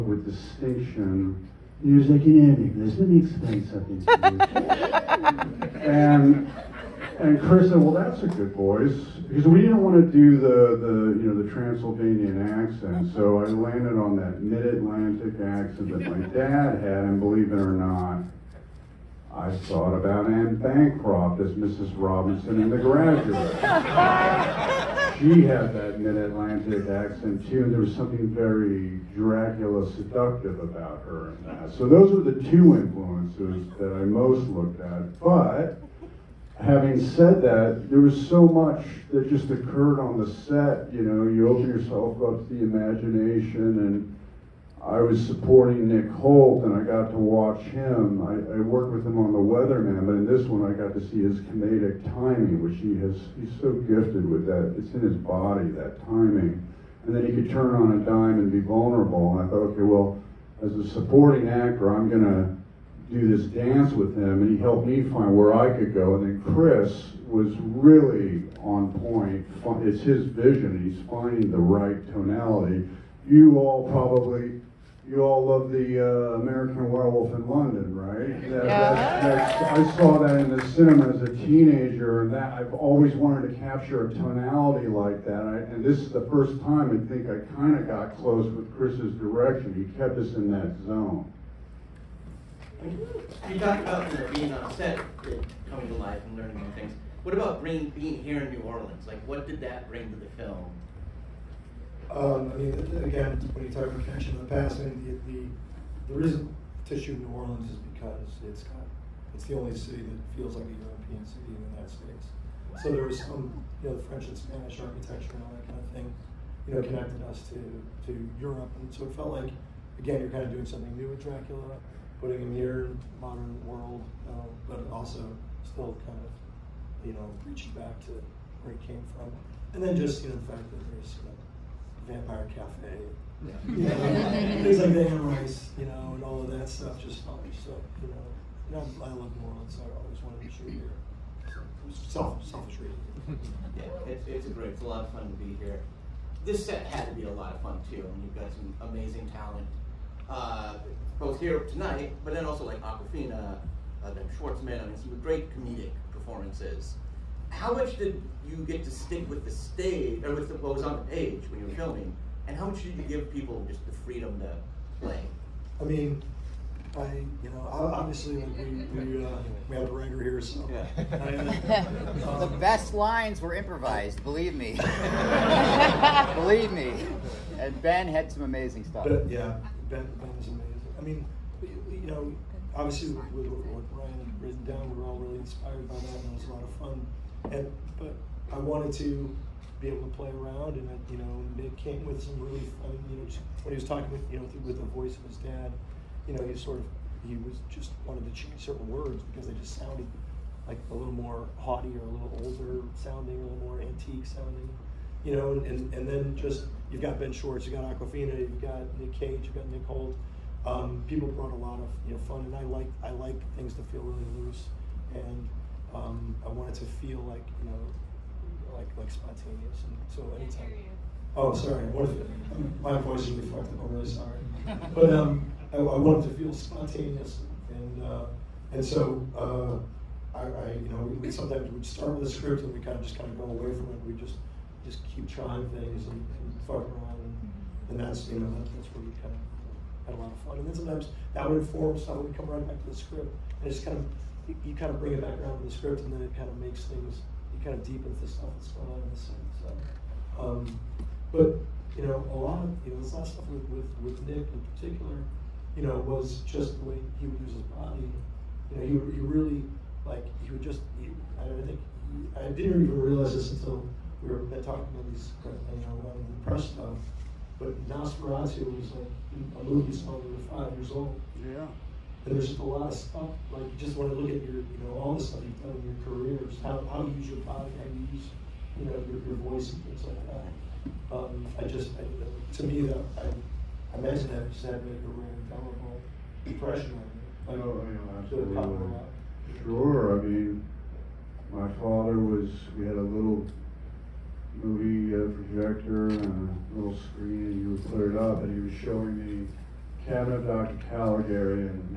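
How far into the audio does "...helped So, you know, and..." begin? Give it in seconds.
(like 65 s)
137 s.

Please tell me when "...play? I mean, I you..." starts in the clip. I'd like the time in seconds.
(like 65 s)
164 s.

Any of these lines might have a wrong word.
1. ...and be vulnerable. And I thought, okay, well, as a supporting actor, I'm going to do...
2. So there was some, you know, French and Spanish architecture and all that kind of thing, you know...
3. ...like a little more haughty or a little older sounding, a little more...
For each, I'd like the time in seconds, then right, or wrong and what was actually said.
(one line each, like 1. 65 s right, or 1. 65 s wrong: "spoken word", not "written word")
1. 58 s right
2. 112 s right
3. 200 s right.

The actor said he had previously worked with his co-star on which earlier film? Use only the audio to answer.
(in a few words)
The Weatherman.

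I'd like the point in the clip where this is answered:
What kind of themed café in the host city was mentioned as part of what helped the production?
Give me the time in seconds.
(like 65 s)
132 s.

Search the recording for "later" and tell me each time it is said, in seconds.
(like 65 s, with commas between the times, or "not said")
not said.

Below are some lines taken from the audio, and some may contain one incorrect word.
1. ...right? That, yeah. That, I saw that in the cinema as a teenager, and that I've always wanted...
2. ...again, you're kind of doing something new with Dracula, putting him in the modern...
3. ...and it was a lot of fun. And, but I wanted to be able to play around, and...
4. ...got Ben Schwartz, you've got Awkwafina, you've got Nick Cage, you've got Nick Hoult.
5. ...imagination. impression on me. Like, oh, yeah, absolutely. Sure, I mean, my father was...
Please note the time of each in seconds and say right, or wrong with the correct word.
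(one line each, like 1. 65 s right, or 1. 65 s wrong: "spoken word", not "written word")
1. 77 s right
2. 119 s right
3. 186 s right
4. 207 s right
5. 286 s wrong: "depression", not "imagination".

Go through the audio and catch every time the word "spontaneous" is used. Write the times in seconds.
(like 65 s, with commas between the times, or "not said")
219 s, 226 s.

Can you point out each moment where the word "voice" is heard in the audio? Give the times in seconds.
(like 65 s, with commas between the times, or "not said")
8 s, 194 s, 223 s, 279 s.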